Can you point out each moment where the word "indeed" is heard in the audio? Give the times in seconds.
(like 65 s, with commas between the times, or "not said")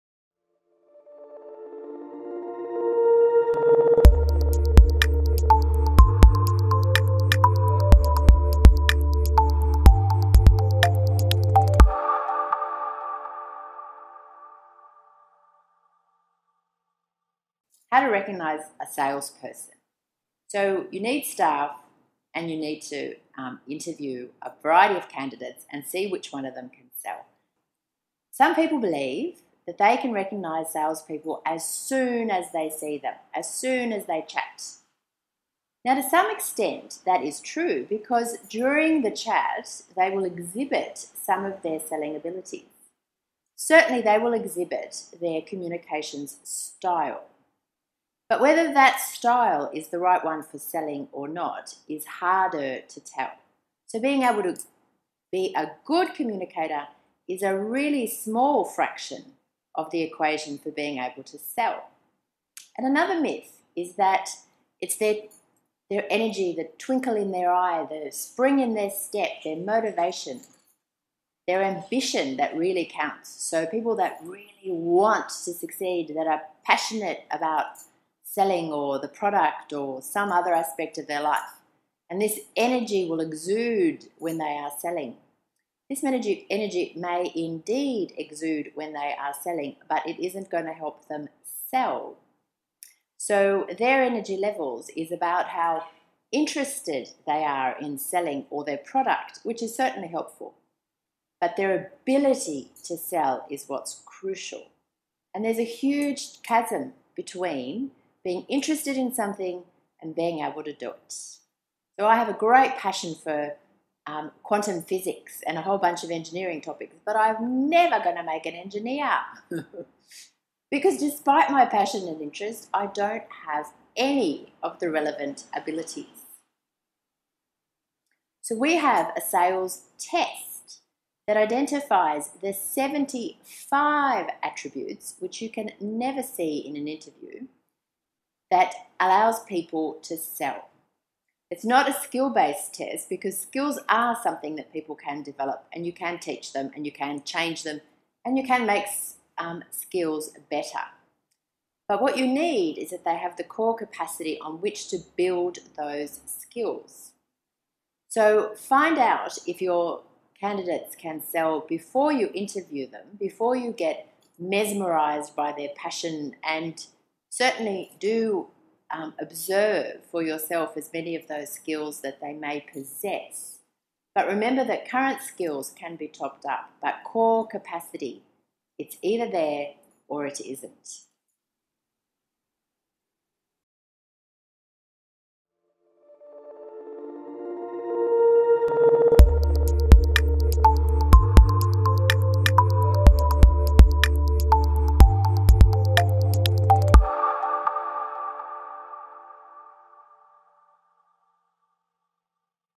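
87 s.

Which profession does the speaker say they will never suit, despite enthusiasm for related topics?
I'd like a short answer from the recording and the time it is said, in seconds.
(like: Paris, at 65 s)
engineer, at 118 s.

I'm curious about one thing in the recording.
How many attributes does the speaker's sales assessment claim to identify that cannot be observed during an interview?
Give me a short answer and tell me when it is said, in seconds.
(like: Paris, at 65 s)
75, at 132 s.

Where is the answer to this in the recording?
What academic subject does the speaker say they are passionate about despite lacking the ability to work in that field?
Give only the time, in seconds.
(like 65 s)
114 s.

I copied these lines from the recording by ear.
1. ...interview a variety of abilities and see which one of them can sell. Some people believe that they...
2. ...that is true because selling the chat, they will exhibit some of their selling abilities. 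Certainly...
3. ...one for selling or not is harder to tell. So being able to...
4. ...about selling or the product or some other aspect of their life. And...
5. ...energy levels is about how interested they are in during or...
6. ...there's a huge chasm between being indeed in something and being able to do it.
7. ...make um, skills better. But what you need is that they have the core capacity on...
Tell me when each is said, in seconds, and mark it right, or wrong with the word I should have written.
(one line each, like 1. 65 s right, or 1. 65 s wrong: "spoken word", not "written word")
1. 23 s wrong: "candidates", not "abilities"
2. 37 s wrong: "during", not "selling"
3. 50 s right
4. 77 s right
5. 94 s wrong: "selling", not "during"
6. 105 s wrong: "interested", not "indeed"
7. 148 s right.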